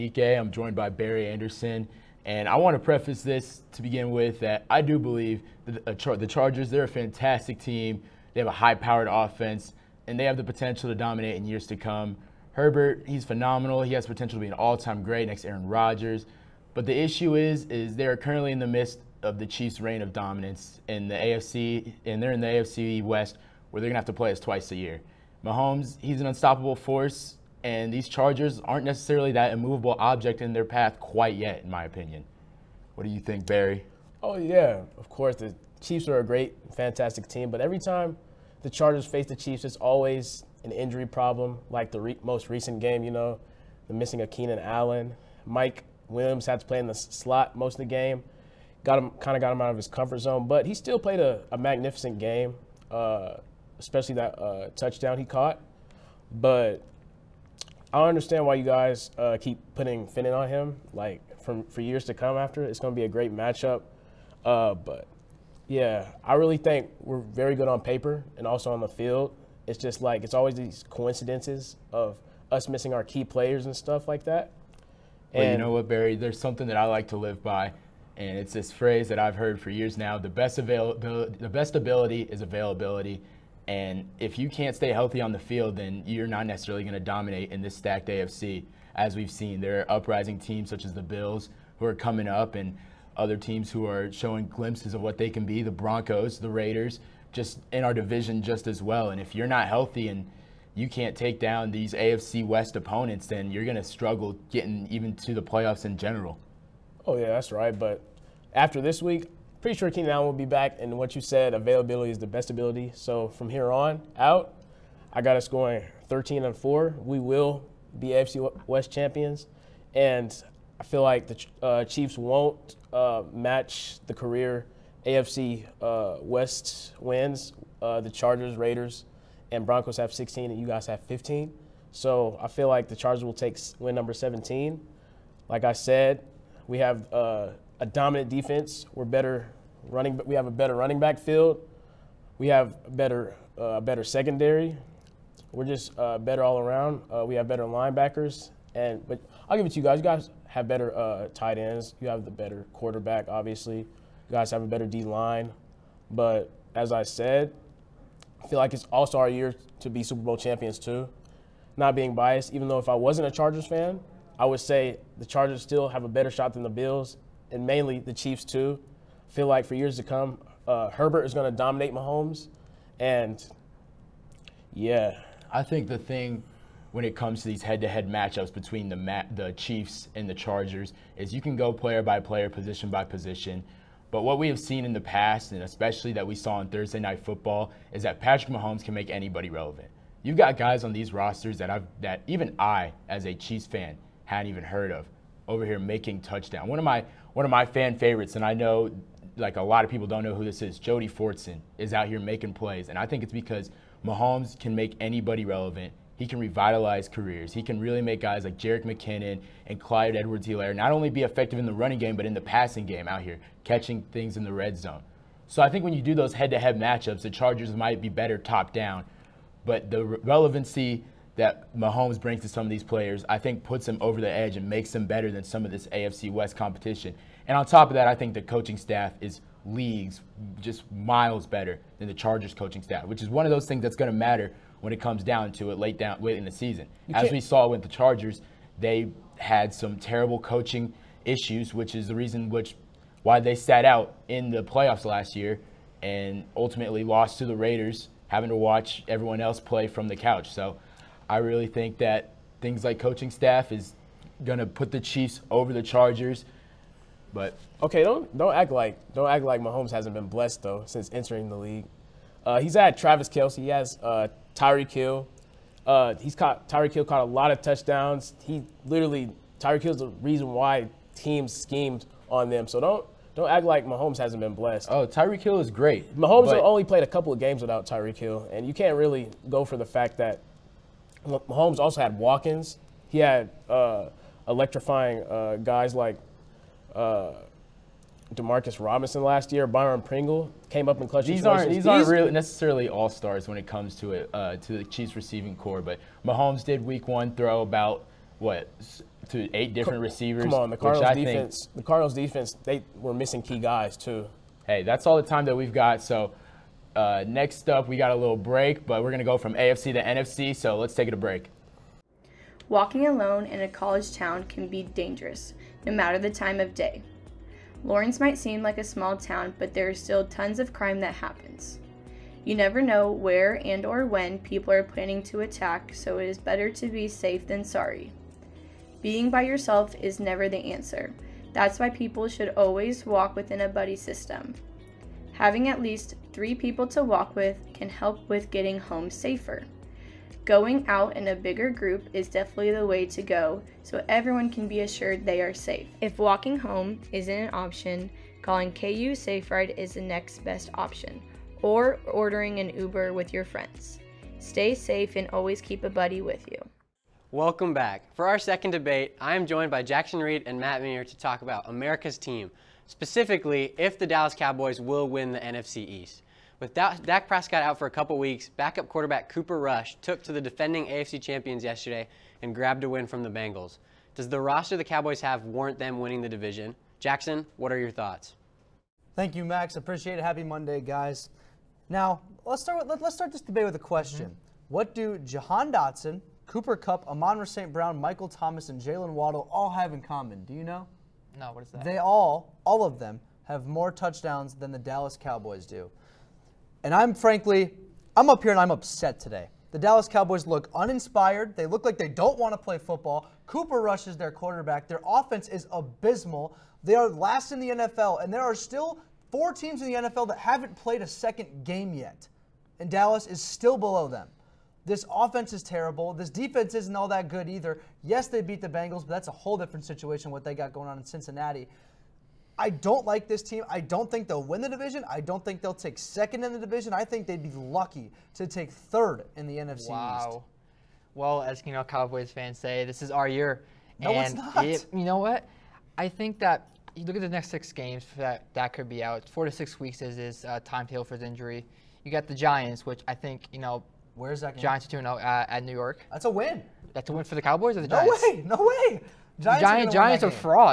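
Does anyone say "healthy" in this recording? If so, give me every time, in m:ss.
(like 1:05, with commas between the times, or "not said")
1:24, 1:39.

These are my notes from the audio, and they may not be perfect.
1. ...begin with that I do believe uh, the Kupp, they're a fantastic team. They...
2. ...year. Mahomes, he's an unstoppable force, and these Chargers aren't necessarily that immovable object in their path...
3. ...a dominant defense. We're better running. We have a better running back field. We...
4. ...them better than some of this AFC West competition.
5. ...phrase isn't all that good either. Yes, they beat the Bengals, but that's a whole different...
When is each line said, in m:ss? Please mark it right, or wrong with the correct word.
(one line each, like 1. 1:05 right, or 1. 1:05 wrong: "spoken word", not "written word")
1. 0:03 wrong: "Chargers", not "Kupp"
2. 0:24 right
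3. 2:17 right
4. 3:44 right
5. 6:56 wrong: "defense", not "phrase".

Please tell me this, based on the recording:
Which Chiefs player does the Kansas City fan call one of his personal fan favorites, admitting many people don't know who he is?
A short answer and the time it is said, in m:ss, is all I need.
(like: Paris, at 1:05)
Jody Fortson, at 3:20.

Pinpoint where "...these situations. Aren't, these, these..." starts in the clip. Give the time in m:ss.
4:51.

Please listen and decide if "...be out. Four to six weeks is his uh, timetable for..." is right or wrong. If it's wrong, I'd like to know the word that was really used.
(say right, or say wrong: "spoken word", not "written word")
right.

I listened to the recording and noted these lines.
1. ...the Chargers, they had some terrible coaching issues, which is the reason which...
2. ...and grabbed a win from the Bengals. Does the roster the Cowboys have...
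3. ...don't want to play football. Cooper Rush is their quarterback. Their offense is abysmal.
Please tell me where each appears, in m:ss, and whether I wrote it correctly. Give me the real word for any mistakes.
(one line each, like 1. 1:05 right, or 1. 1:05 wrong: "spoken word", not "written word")
1. 3:57 right
2. 6:12 right
3. 6:42 right.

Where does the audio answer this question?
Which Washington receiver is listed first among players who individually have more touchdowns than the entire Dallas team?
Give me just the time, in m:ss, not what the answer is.
6:25.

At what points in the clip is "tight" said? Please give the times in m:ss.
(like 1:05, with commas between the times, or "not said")
2:31.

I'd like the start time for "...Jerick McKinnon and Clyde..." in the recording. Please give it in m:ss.
3:28.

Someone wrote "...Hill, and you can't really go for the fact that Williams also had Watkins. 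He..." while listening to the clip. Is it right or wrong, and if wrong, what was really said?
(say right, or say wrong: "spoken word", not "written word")
wrong: "Mahomes", not "Williams".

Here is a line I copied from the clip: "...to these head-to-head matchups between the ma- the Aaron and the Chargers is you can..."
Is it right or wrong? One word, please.
wrong.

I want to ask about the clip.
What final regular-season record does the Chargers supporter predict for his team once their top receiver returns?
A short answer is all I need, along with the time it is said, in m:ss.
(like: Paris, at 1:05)
13 and 4, at 1:56.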